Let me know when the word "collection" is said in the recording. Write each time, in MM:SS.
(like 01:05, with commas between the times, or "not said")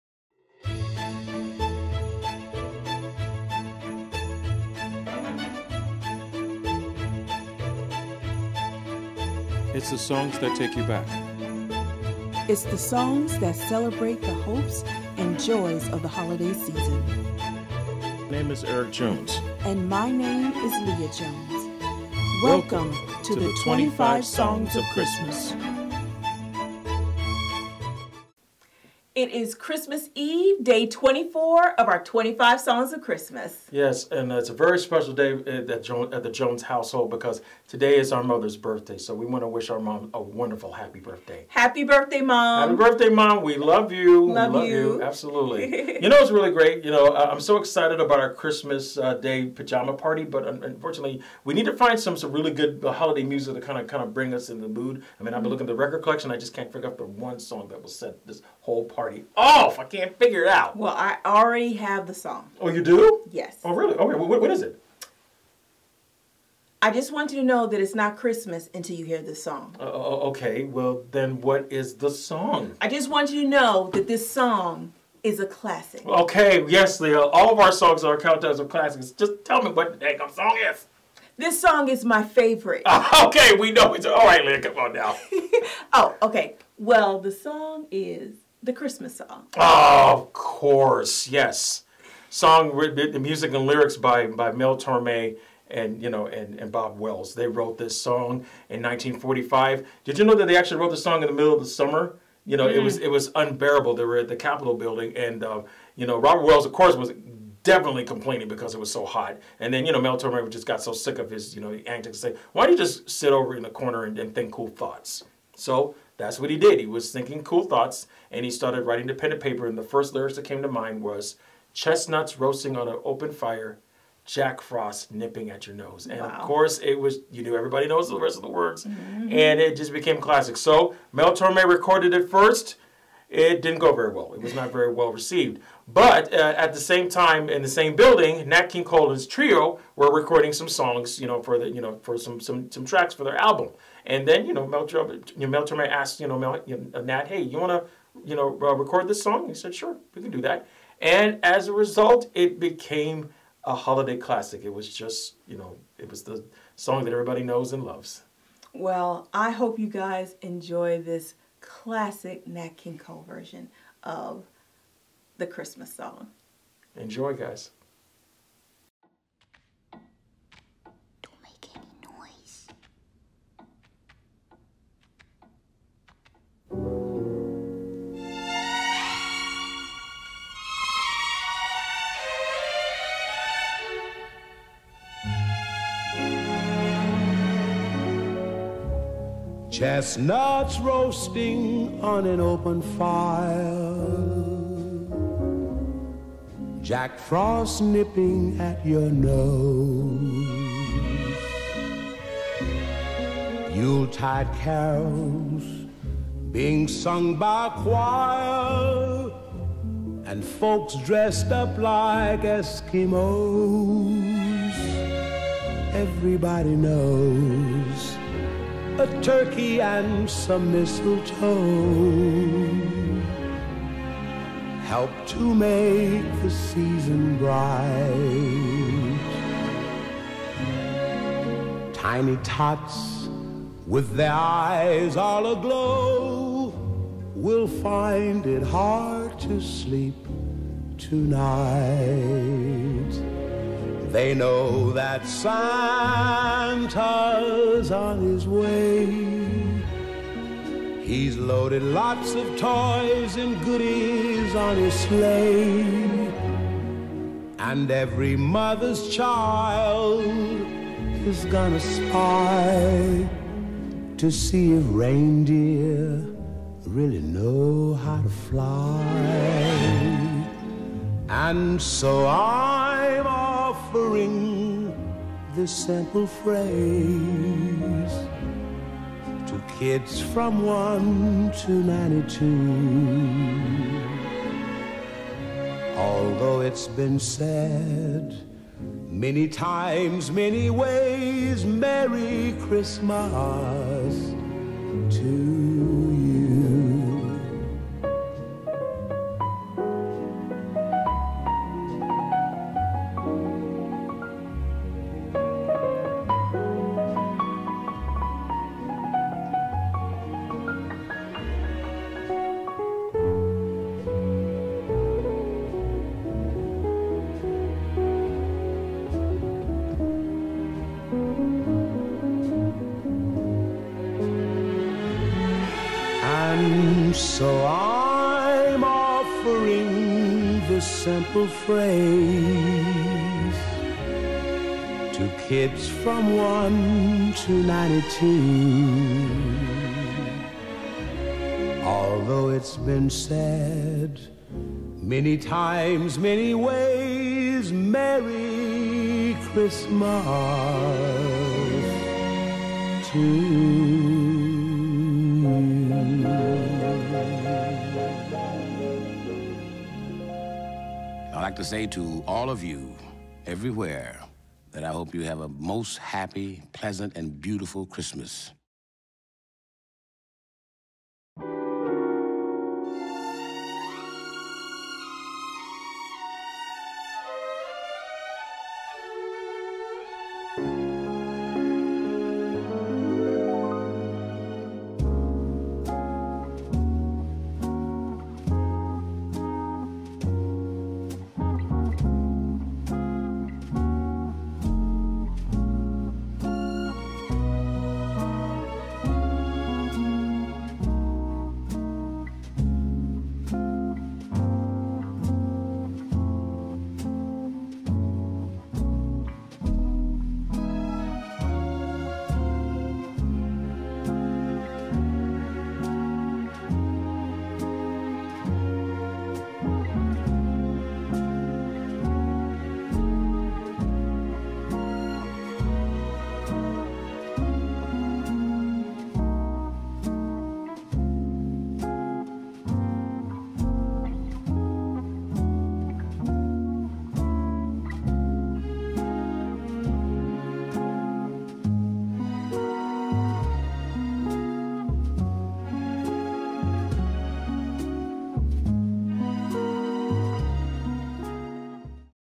00:56.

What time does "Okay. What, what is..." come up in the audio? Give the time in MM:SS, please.
01:03.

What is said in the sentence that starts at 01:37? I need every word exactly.
They wrote this song in 1945.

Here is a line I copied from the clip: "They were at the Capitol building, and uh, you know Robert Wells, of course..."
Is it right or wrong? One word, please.
right.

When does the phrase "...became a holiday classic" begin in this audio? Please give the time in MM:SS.
02:32.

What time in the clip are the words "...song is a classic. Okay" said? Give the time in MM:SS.
01:14.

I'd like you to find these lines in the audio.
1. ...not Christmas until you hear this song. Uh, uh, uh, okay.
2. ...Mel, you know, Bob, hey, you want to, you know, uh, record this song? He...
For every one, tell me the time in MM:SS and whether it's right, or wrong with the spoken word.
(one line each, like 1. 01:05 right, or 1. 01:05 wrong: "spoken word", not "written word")
1. 01:07 right
2. 02:26 wrong: "Nat", not "Bob".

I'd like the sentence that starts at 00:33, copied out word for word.
Yes, and it's a very special day uh, at the Jones household because today is our mother's birthday.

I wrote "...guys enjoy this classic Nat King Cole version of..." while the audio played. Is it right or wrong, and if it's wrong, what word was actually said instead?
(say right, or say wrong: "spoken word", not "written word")
right.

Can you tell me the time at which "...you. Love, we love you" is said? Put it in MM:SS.
00:43.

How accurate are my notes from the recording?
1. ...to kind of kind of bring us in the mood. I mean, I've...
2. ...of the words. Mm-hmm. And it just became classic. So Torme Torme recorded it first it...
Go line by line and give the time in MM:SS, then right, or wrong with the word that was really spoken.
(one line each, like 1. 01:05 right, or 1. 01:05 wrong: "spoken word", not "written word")
1. 00:53 right
2. 02:08 wrong: "Mel", not "Torme".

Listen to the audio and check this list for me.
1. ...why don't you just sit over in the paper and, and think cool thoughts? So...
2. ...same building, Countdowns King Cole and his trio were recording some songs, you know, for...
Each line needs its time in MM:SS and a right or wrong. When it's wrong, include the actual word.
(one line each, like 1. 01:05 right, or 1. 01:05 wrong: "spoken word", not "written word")
1. 01:52 wrong: "corner", not "paper"
2. 02:17 wrong: "Nat", not "Countdowns".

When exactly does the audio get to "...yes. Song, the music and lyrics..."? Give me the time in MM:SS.
01:31.